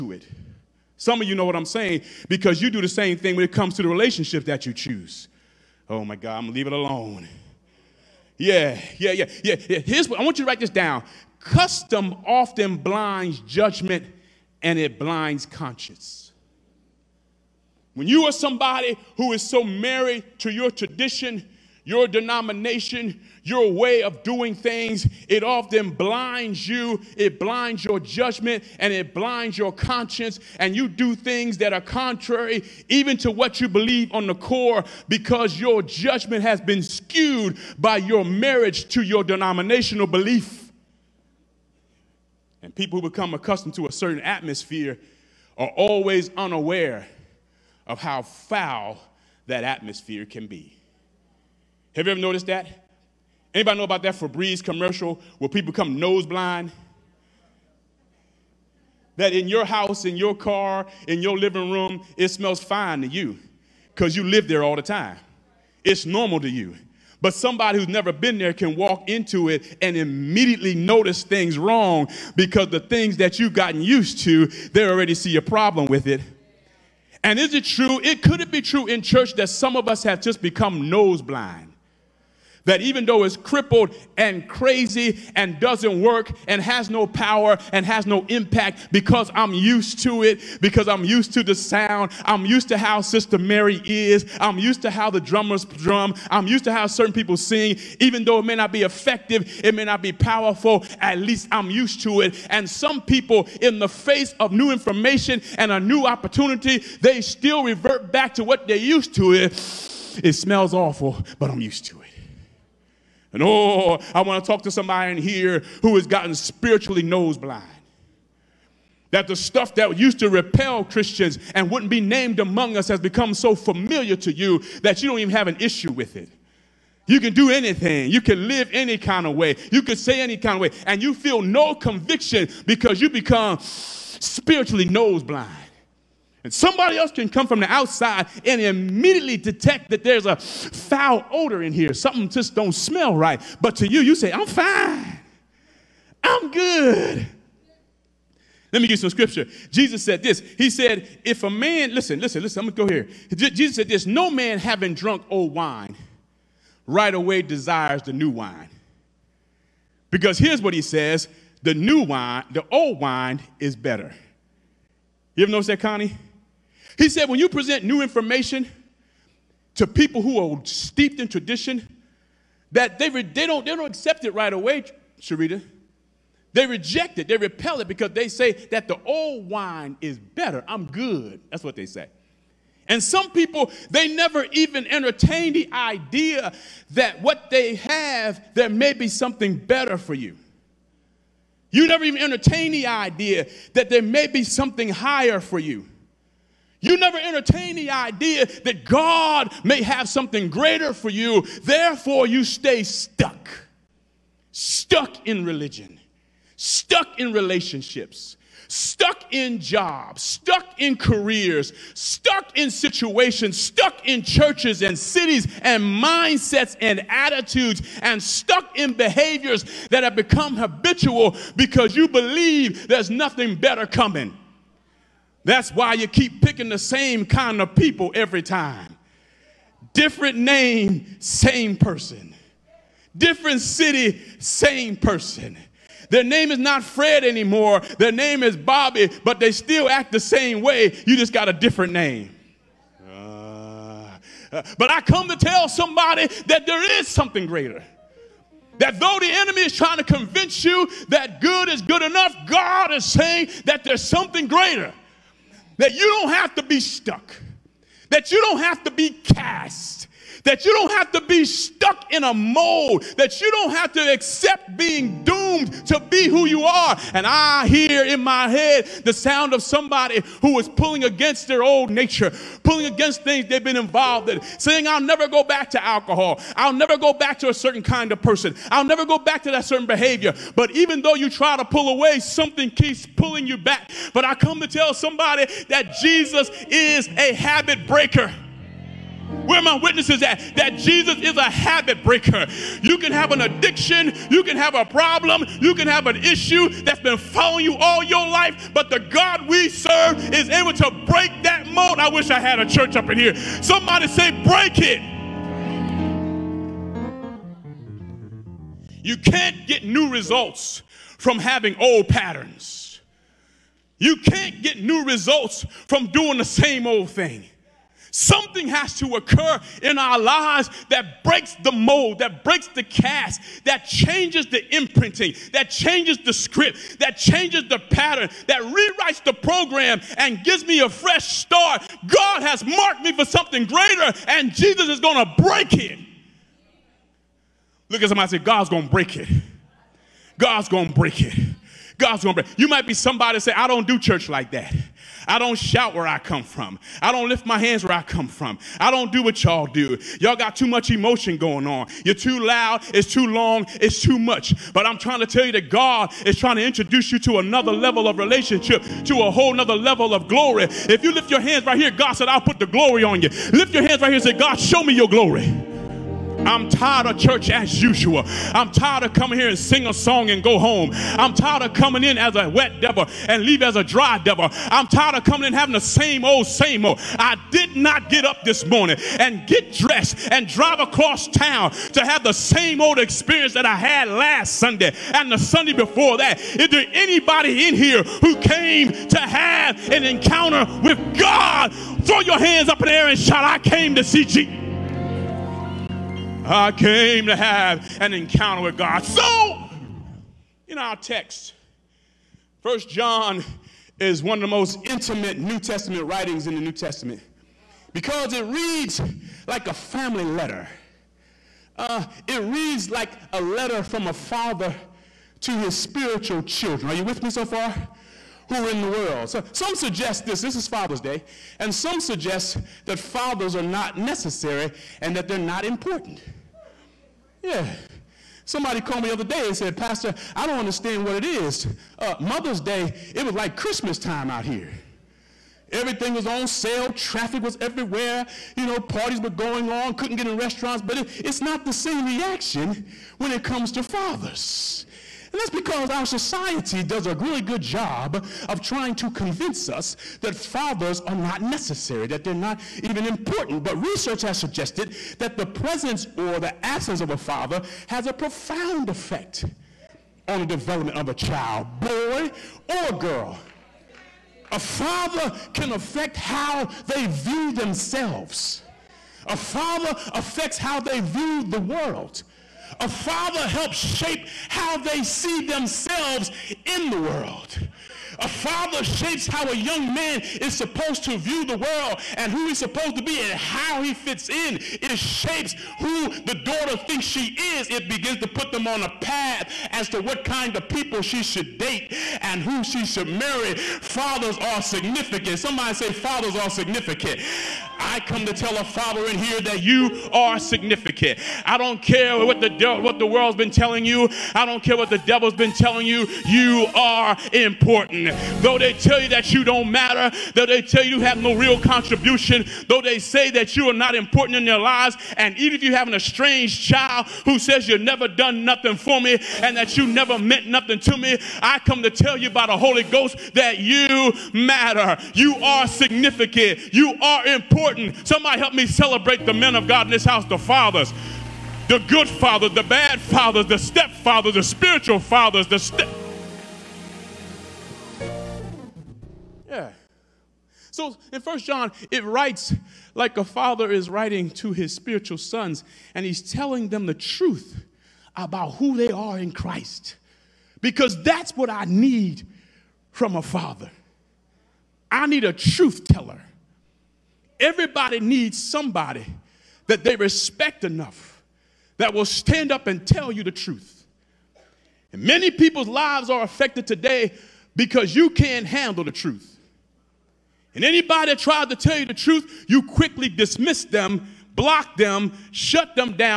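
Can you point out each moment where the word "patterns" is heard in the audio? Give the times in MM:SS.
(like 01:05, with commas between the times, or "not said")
05:12, 05:27.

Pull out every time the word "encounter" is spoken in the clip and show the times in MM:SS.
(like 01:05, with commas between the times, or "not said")
06:30, 06:38.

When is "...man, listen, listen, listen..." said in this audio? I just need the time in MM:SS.
02:31.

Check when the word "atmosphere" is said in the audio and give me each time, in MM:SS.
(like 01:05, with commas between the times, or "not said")
00:44, 00:49.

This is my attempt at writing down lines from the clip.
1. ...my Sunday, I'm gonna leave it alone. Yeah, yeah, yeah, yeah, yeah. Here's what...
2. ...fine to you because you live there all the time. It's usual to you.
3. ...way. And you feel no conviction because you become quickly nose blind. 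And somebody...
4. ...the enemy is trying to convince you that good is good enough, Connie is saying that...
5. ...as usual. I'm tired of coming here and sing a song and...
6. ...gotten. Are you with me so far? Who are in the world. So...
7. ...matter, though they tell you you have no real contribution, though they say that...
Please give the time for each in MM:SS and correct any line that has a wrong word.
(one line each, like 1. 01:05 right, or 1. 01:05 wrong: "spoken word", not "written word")
1. 00:06 wrong: "God", not "Sunday"
2. 01:02 wrong: "normal", not "usual"
3. 02:10 wrong: "spiritually", not "quickly"
4. 04:09 wrong: "God", not "Connie"
5. 06:07 right
6. 06:56 wrong: "children", not "gotten"
7. 08:29 right.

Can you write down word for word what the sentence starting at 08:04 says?
It shapes who the daughter thinks she is.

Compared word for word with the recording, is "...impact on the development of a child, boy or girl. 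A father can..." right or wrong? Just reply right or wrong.
wrong.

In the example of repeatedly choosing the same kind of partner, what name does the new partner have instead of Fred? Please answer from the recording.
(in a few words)
Bobby.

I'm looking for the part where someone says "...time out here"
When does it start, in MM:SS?
07:13.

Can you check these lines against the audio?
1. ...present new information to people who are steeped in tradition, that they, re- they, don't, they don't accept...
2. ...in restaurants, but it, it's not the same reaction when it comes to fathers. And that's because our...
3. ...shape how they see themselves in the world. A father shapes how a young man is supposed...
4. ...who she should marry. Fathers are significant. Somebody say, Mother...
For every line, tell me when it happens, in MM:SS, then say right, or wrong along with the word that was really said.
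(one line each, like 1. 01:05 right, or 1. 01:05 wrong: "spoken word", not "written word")
1. 02:47 right
2. 07:20 right
3. 07:53 right
4. 08:12 wrong: "Fathers", not "Mother".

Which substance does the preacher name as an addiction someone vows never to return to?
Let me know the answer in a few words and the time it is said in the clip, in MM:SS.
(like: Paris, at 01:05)
Alcohol, at 04:35.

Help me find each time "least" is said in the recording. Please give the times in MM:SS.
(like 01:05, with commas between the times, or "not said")
01:41.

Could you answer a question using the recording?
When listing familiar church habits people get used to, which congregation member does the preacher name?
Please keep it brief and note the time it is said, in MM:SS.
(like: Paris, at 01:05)
Sister Mary, at 01:33.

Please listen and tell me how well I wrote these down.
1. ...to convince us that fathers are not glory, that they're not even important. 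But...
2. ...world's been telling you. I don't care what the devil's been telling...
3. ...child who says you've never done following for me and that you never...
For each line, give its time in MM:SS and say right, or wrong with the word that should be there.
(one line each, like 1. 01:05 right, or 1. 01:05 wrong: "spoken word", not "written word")
1. 07:28 wrong: "necessary", not "glory"
2. 08:23 right
3. 08:36 wrong: "nothing", not "following".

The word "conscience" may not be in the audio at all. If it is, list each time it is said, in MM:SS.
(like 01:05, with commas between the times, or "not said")
00:15, 00:29.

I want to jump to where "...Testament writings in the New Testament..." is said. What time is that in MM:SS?
06:45.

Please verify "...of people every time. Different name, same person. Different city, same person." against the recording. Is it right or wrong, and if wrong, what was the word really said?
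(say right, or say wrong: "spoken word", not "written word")
right.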